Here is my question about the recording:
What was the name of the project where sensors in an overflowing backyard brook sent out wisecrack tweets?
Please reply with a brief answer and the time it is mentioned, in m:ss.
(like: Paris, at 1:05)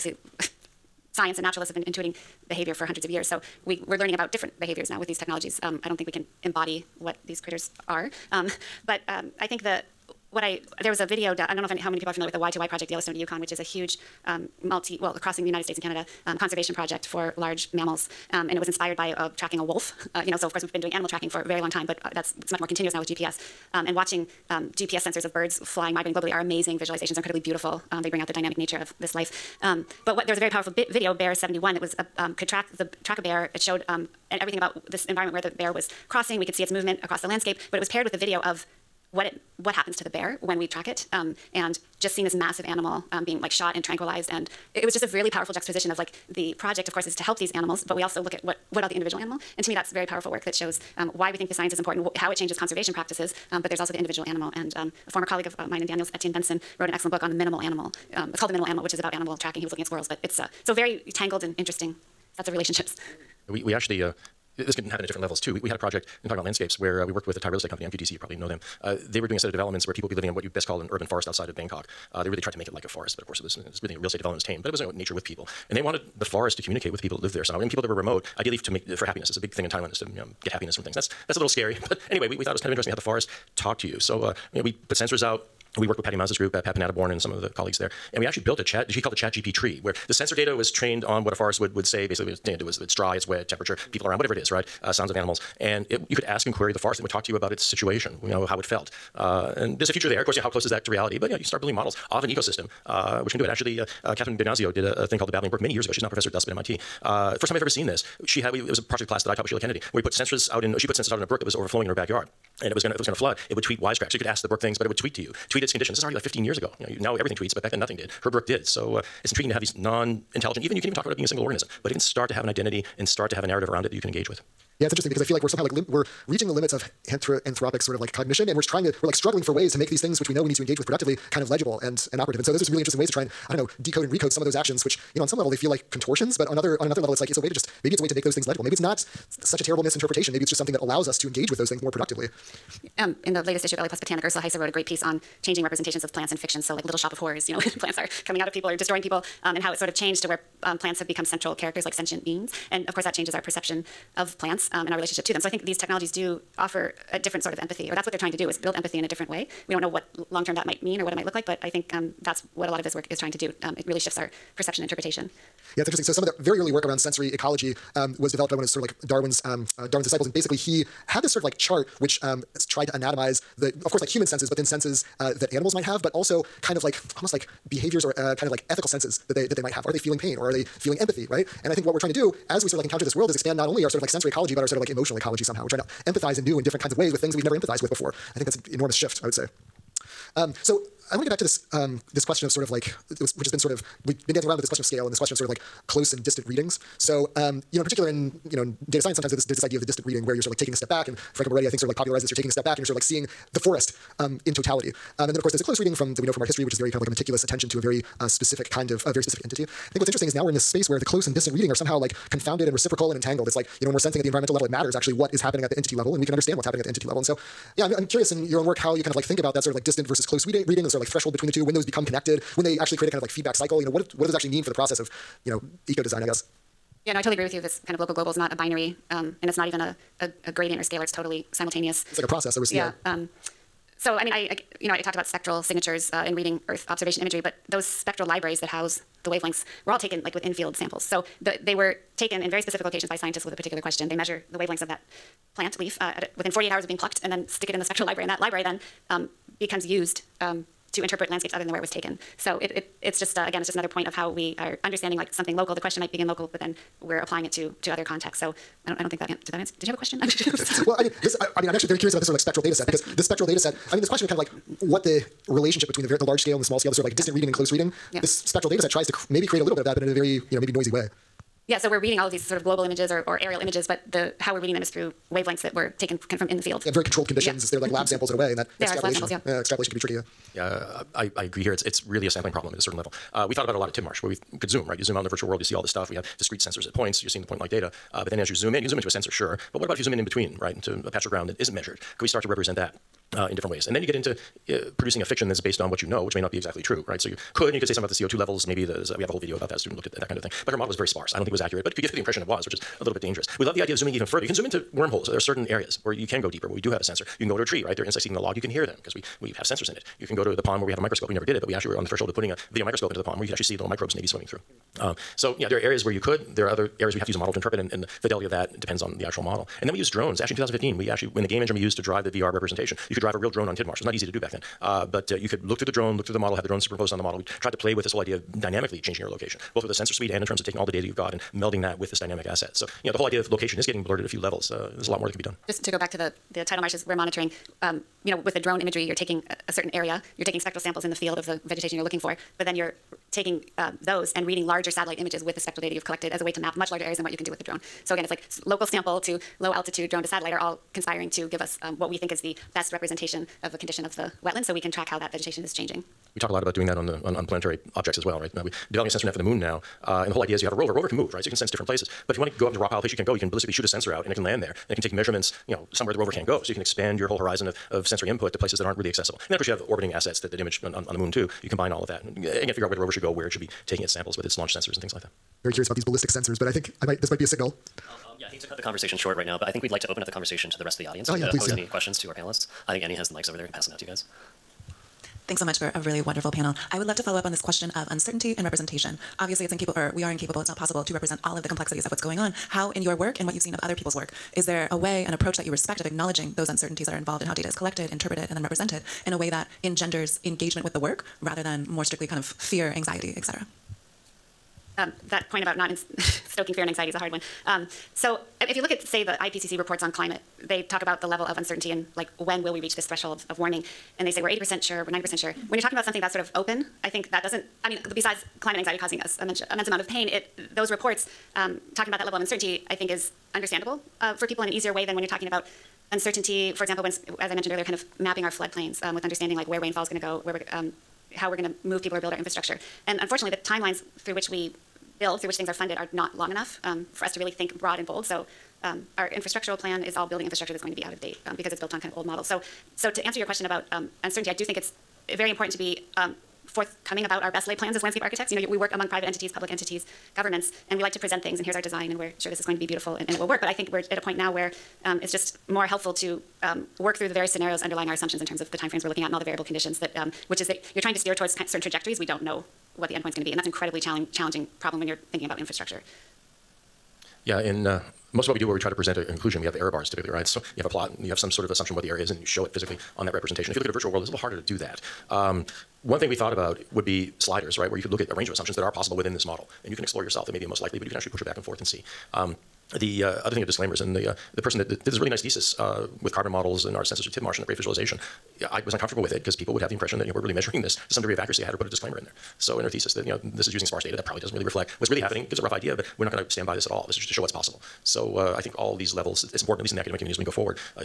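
Babbling Brook, at 1:45.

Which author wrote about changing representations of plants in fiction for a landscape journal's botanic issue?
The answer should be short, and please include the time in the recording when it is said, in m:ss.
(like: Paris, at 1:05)
Ursula Heise, at 2:24.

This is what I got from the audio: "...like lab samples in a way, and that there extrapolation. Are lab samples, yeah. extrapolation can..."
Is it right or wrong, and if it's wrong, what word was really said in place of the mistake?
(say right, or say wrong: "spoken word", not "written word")
right.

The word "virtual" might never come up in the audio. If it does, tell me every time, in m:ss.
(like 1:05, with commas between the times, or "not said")
4:45, 7:53.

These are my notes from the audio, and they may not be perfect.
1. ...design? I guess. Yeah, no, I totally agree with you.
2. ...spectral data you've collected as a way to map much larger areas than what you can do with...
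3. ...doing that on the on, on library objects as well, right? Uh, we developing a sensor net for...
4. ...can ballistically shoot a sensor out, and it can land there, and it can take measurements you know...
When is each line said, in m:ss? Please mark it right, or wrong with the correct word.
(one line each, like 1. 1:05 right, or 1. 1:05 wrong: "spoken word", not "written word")
1. 3:46 right
2. 5:45 right
3. 5:56 wrong: "planetary", not "library"
4. 6:03 right.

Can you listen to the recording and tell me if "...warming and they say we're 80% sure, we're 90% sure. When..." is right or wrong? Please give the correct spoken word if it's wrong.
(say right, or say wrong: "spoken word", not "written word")
right.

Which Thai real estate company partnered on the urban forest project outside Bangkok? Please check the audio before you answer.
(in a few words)
MQDC.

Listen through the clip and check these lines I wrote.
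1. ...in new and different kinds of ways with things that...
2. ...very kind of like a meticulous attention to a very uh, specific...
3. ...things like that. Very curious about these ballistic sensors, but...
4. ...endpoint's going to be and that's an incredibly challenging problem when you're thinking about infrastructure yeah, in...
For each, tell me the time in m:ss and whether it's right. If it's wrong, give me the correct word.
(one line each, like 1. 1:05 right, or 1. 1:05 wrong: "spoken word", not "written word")
1. 3:06 right
2. 3:26 right
3. 6:15 right
4. 7:43 right.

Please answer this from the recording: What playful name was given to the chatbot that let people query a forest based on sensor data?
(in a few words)
chat GP tree.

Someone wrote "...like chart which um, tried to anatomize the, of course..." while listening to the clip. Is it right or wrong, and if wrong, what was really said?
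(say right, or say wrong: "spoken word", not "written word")
right.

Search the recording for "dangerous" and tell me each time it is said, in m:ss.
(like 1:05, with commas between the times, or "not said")
5:03.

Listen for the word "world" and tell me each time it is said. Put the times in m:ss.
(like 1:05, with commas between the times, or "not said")
3:03, 4:45, 7:54.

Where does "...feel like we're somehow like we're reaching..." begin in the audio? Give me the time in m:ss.
2:05.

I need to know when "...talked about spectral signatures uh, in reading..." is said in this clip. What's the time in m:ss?
3:55.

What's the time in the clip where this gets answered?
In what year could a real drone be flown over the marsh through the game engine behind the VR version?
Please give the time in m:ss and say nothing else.
5:20.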